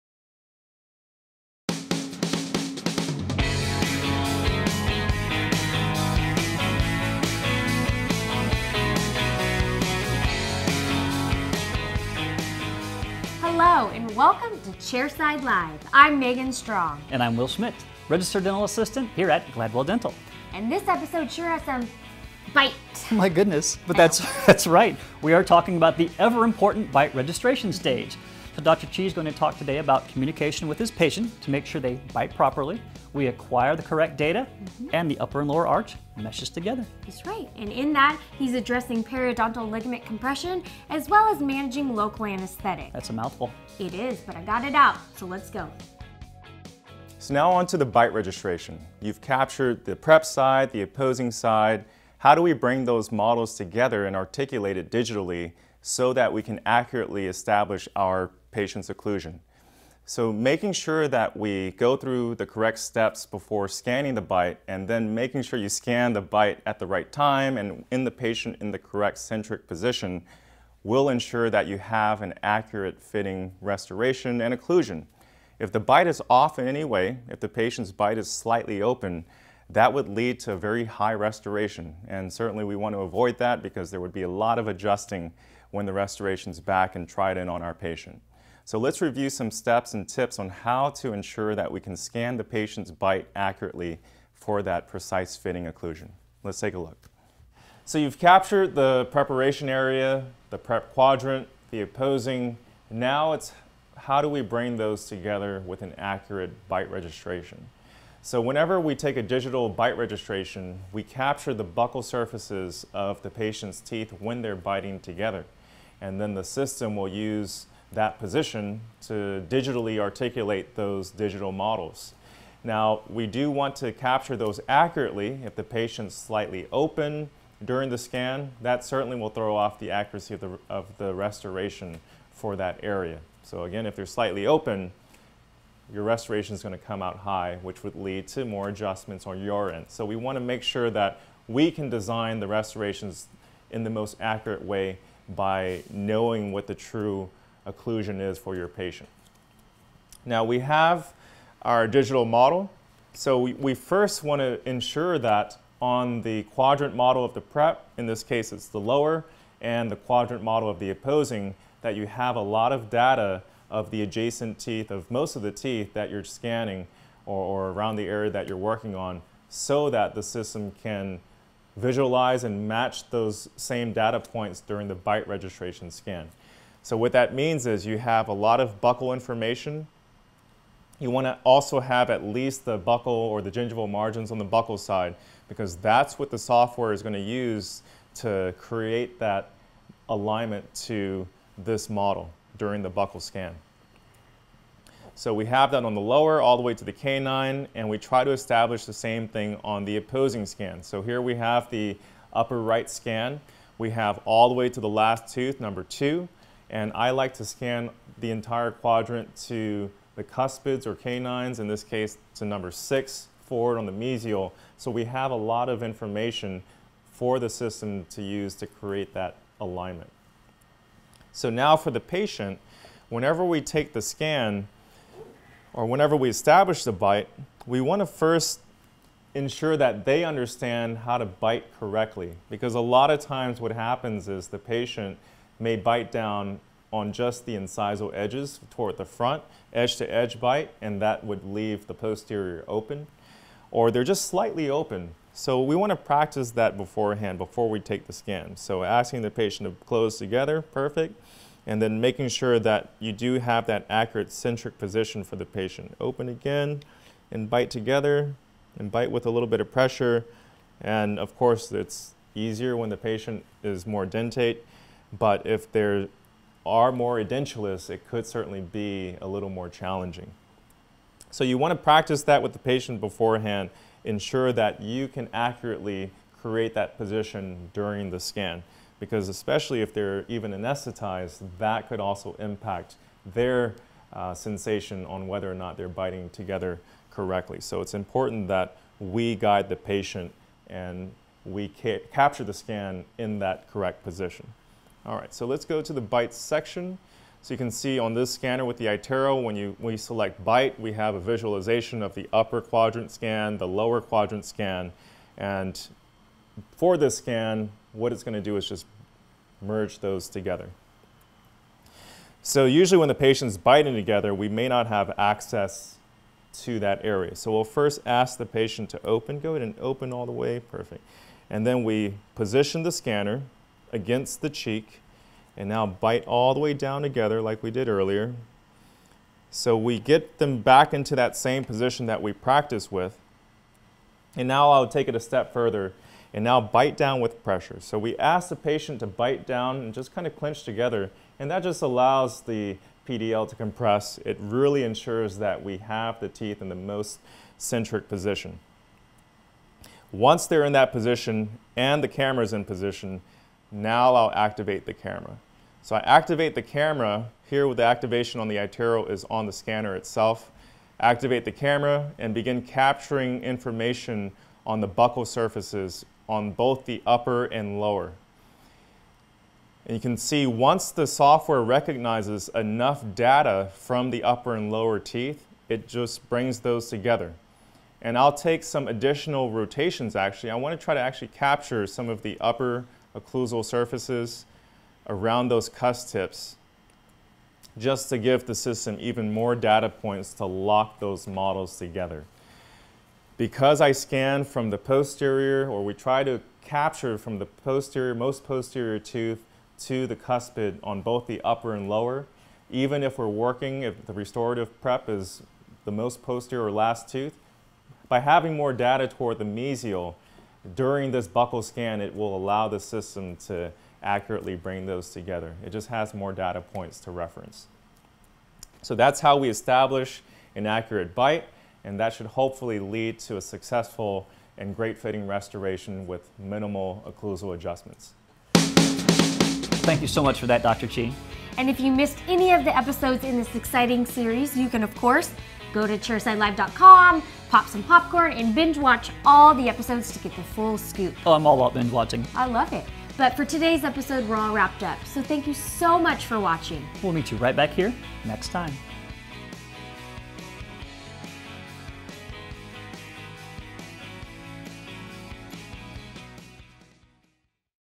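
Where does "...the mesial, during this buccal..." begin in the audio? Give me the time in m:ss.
6:49.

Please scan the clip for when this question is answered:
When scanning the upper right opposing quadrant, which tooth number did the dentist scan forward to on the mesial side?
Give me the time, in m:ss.
3:32.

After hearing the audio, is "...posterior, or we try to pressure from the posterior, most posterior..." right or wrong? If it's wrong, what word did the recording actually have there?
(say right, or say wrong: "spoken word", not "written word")
wrong: "capture", not "pressure".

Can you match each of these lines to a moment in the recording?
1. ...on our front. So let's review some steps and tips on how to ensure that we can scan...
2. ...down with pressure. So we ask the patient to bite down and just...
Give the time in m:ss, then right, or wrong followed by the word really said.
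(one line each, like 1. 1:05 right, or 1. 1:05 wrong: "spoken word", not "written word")
1. 1:27 wrong: "patient", not "front"
2. 5:36 right.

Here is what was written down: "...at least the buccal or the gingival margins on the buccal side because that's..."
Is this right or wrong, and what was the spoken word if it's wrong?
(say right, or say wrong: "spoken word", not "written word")
right.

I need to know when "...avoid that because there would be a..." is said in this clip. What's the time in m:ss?
1:22.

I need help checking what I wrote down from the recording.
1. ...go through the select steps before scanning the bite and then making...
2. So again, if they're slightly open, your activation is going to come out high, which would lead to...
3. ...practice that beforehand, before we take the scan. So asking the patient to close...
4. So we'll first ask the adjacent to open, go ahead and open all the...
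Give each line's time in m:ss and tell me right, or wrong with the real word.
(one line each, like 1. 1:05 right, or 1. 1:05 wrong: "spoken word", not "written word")
1. 1:01 wrong: "correct", not "select"
2. 2:13 wrong: "restoration", not "activation"
3. 4:05 right
4. 5:17 wrong: "patient", not "adjacent".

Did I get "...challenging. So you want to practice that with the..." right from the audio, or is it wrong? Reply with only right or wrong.
right.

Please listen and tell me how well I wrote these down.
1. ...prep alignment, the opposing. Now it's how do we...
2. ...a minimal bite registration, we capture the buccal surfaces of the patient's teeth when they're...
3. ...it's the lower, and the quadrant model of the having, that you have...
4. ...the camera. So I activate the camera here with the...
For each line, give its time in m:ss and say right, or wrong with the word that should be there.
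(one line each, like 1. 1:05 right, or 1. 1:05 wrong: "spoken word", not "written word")
1. 1:40 wrong: "quadrant", not "alignment"
2. 1:49 wrong: "digital", not "minimal"
3. 2:38 wrong: "opposing", not "having"
4. 5:54 right.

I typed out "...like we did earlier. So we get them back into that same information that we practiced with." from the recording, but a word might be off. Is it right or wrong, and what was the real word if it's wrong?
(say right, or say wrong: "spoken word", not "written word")
wrong: "position", not "information".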